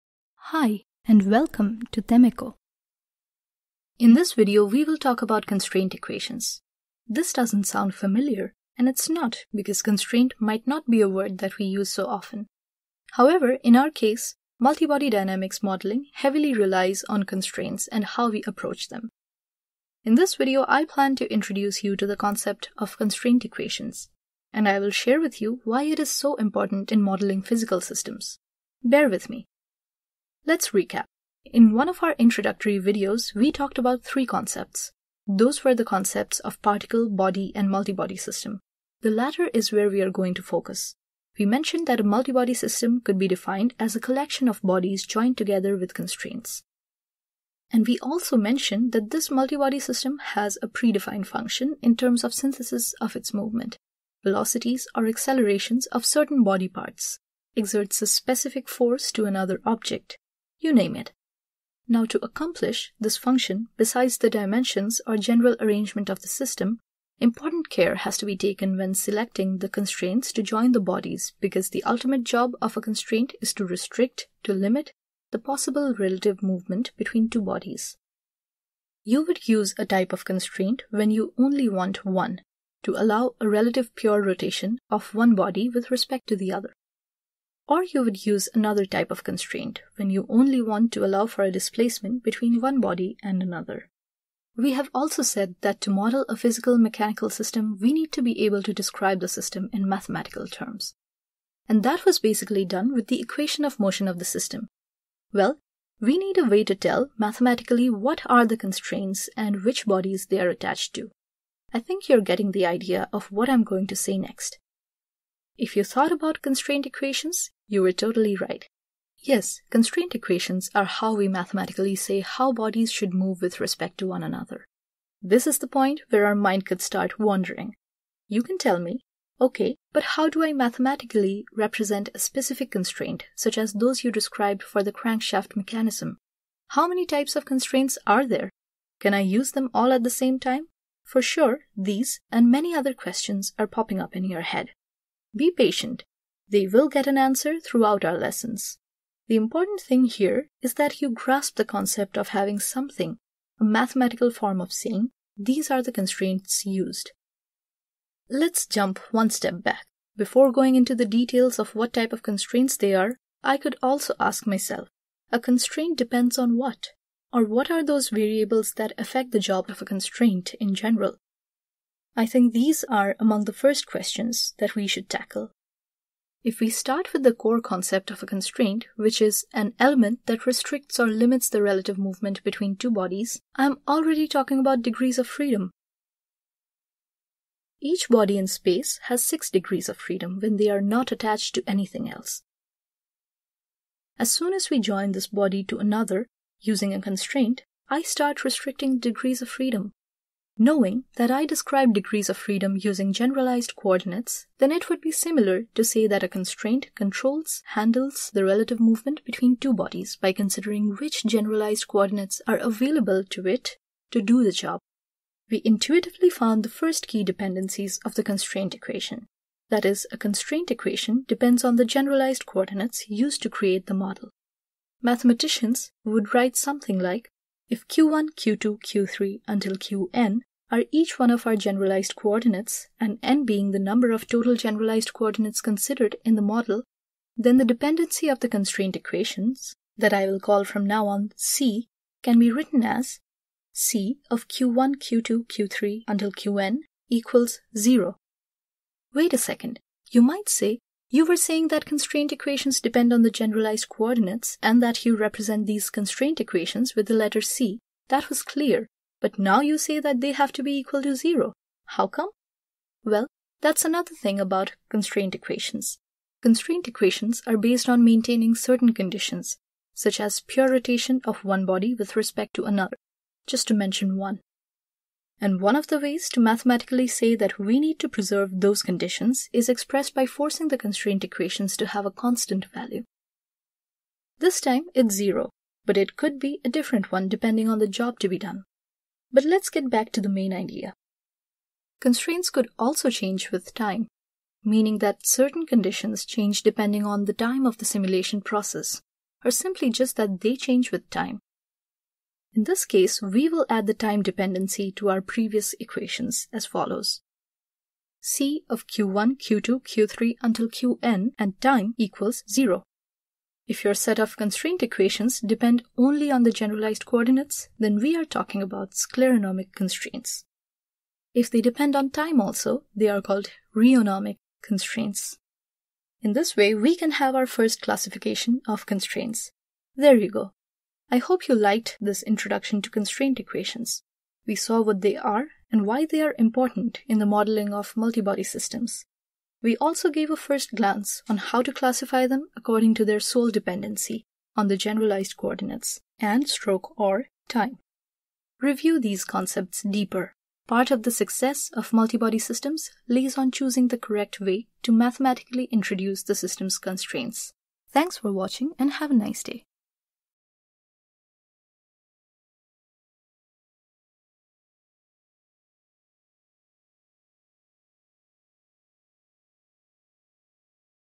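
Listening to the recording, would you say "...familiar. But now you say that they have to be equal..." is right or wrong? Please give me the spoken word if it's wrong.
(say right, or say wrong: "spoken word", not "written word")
wrong: "clear", not "familiar".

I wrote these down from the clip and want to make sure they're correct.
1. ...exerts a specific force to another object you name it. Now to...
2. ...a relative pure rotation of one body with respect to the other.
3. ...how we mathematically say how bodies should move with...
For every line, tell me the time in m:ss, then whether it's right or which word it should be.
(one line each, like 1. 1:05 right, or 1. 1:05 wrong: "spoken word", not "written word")
1. 0:57 right
2. 1:23 right
3. 2:00 right.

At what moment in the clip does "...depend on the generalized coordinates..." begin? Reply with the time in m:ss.
4:12.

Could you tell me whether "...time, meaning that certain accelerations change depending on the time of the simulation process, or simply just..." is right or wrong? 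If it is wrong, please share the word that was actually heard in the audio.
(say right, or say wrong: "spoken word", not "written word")
wrong: "conditions", not "accelerations".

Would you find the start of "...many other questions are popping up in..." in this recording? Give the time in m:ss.
2:22.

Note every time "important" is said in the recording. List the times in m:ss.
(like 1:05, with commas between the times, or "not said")
0:26, 1:07, 2:29, 5:36.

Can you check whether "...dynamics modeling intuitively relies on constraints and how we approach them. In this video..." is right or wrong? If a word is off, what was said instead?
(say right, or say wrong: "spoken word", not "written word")
wrong: "heavily", not "intuitively".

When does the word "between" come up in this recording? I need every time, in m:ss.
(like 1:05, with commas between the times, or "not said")
1:16, 1:32, 3:02, 3:29.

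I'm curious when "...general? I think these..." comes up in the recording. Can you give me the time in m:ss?
2:50.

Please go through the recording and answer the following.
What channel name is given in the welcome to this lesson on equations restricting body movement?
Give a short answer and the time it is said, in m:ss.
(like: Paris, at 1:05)
Temeko, at 0:02.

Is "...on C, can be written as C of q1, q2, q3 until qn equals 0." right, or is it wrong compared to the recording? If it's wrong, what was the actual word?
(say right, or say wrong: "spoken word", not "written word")
right.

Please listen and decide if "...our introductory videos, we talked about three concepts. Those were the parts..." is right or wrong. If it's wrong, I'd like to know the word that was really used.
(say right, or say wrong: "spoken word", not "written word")
wrong: "concepts", not "parts".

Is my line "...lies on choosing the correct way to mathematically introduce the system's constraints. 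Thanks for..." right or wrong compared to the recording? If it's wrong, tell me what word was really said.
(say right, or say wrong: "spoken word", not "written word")
right.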